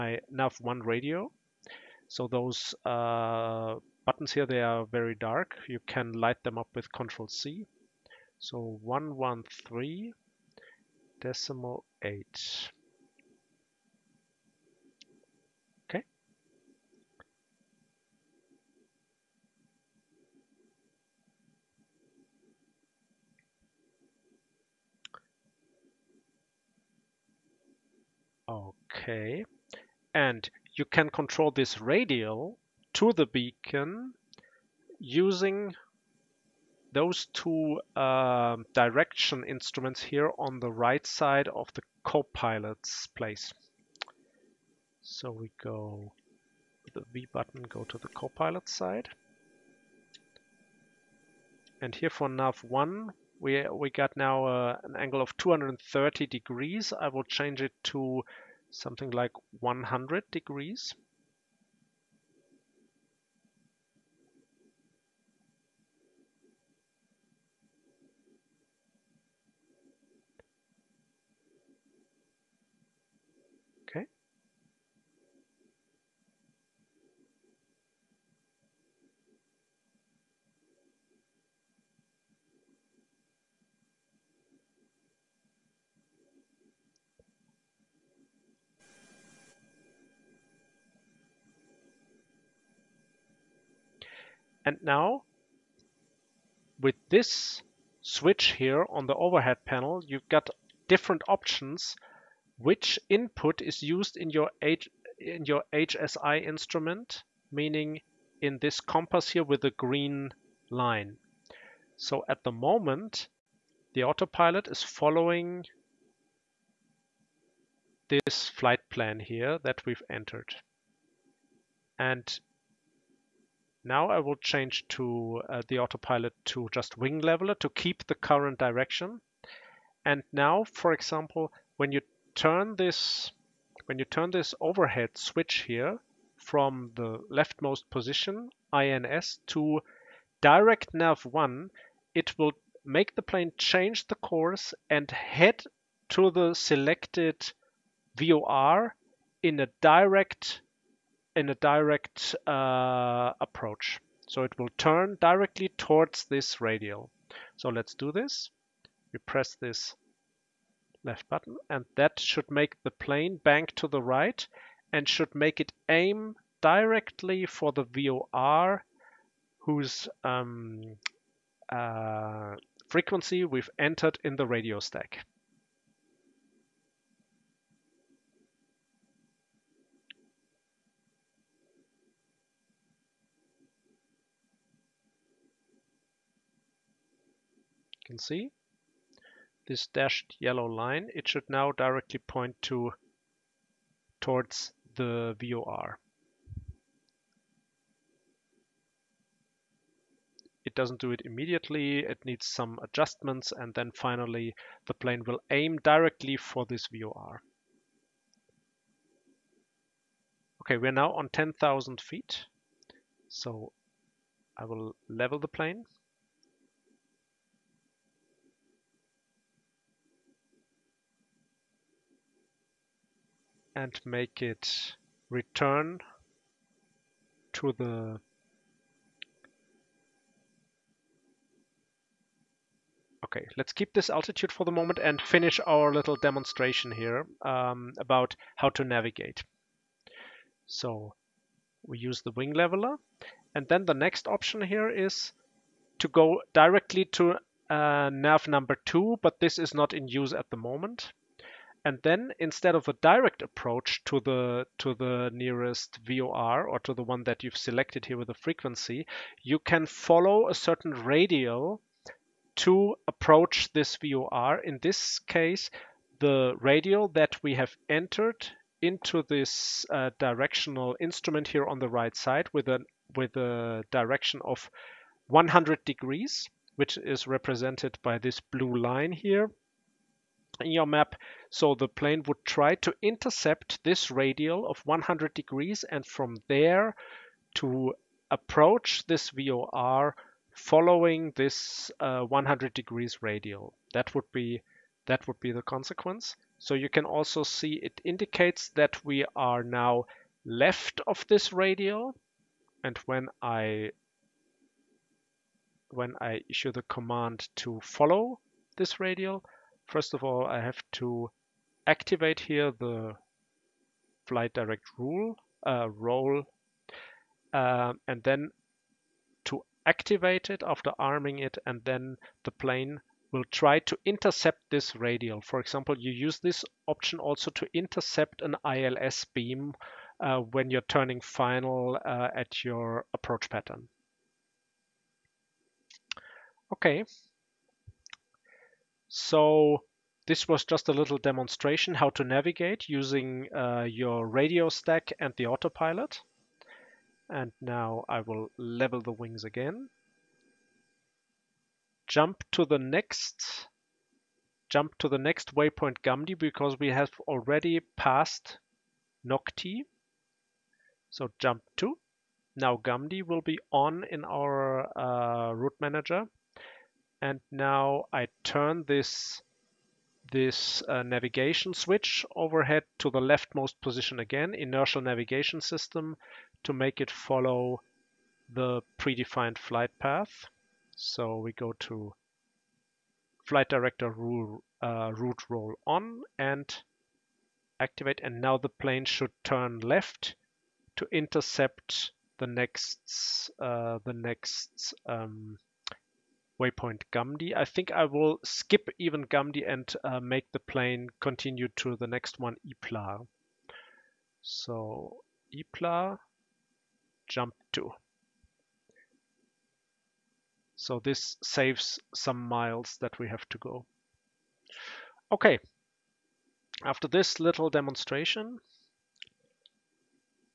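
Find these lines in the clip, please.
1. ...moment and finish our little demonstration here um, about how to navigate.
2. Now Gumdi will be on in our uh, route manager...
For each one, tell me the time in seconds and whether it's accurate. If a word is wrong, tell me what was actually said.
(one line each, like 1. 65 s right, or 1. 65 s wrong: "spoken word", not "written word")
1. 234 s right
2. 362 s right.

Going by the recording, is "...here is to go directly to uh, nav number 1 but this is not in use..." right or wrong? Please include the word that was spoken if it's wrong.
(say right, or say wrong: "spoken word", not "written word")
wrong: "2", not "1".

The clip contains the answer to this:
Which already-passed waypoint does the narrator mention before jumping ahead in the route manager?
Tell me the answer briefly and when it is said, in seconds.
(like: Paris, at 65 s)
Nocti, at 359 s.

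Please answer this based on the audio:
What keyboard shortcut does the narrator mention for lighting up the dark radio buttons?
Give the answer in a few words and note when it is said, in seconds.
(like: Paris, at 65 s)
Control C, at 6 s.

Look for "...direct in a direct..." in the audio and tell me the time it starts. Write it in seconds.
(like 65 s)
149 s.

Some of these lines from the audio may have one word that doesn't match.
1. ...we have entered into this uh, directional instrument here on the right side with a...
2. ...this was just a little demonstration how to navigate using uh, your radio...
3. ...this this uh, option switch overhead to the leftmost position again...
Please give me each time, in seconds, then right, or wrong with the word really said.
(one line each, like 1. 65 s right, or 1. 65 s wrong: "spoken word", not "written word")
1. 267 s right
2. 340 s right
3. 368 s wrong: "navigation", not "option".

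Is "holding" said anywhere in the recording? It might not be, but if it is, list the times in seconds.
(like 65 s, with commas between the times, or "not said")
not said.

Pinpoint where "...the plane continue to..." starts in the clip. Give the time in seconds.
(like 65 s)
400 s.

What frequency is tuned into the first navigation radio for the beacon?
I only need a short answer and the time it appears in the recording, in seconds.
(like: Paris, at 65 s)
113.8, at 8 s.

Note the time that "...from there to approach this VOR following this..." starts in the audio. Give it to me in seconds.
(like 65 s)
286 s.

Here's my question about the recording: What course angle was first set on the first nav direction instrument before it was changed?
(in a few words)
230 degrees.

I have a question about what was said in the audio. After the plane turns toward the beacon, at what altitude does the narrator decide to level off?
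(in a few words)
10,000 feet.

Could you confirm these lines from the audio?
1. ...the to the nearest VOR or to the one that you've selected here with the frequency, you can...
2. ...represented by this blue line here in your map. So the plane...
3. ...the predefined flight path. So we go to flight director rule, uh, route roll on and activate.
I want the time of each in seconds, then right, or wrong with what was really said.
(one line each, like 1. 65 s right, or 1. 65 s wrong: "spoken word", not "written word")
1. 254 s right
2. 277 s right
3. 378 s right.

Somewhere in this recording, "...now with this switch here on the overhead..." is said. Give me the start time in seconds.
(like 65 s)
94 s.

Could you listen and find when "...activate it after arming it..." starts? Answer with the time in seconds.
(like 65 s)
319 s.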